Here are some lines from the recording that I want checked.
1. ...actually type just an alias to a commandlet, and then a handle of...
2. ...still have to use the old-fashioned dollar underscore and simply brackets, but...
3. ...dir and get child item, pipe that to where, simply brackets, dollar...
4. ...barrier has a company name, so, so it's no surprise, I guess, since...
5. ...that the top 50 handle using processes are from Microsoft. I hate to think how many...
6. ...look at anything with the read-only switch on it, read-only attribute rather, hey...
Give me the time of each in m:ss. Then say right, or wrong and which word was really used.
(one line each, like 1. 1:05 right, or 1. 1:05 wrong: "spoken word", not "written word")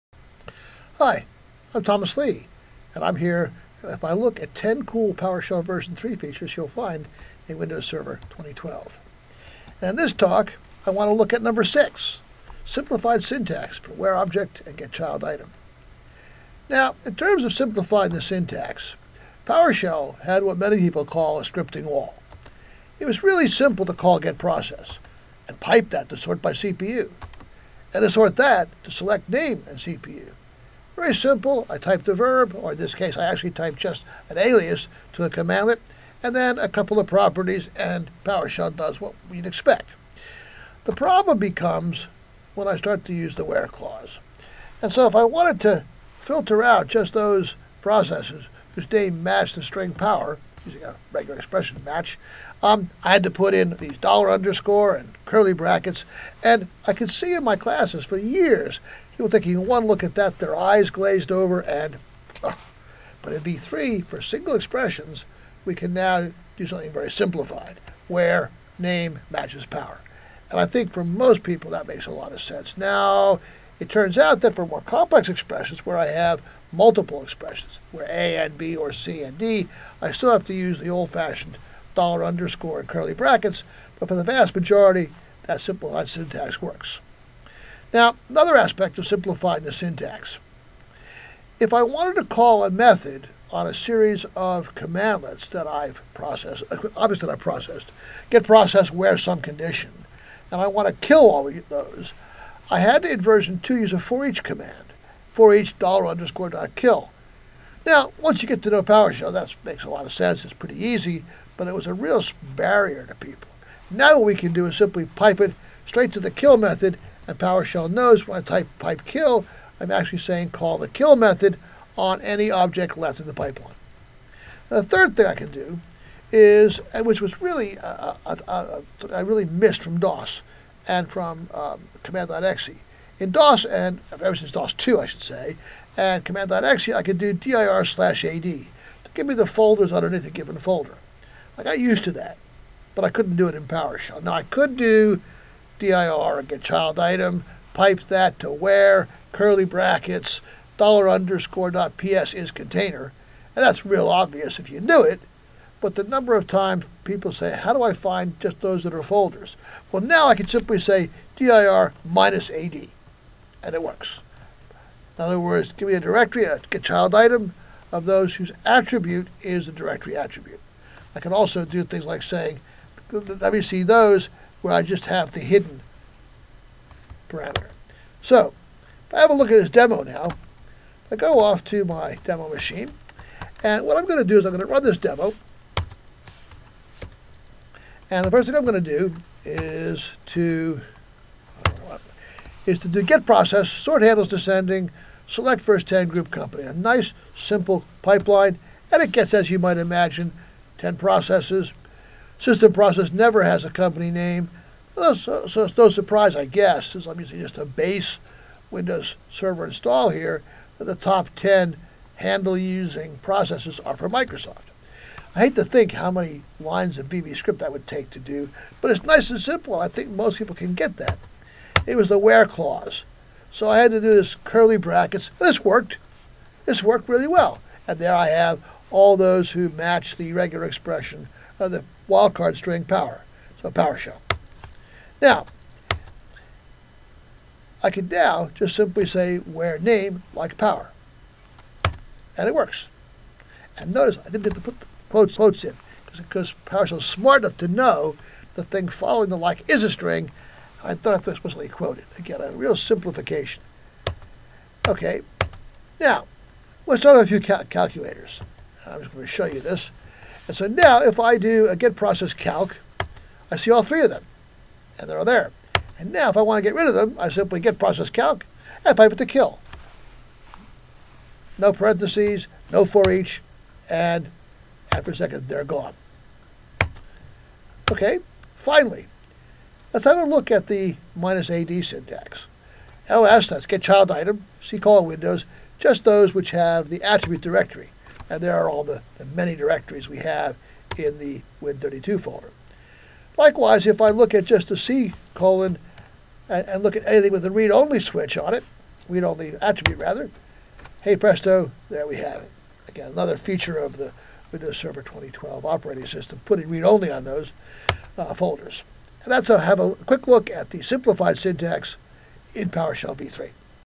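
1. 0:33 wrong: "couple", not "handle"
2. 1:20 wrong: "curly", not "simply"
3. 2:25 wrong: "curly", not "simply"
4. 3:23 wrong: "never", not "barrier"
5. 3:30 wrong: "10", not "50"
6. 4:56 right.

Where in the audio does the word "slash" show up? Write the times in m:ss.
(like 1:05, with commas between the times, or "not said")
2:17.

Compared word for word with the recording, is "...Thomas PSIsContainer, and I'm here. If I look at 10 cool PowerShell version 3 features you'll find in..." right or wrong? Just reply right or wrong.
wrong.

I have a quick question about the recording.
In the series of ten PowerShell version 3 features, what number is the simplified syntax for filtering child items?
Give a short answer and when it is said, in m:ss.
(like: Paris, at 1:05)
6, at 0:11.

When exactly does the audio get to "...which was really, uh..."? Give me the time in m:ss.
2:07.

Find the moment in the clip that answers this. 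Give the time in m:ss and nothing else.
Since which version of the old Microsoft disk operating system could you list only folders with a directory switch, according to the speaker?
2:14.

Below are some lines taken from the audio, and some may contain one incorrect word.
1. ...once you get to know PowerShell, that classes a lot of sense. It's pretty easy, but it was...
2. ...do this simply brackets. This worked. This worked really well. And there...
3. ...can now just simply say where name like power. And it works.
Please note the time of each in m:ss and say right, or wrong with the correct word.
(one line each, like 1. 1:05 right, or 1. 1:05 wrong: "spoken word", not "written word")
1. 1:48 wrong: "makes", not "classes"
2. 3:44 wrong: "curly", not "simply"
3. 3:57 right.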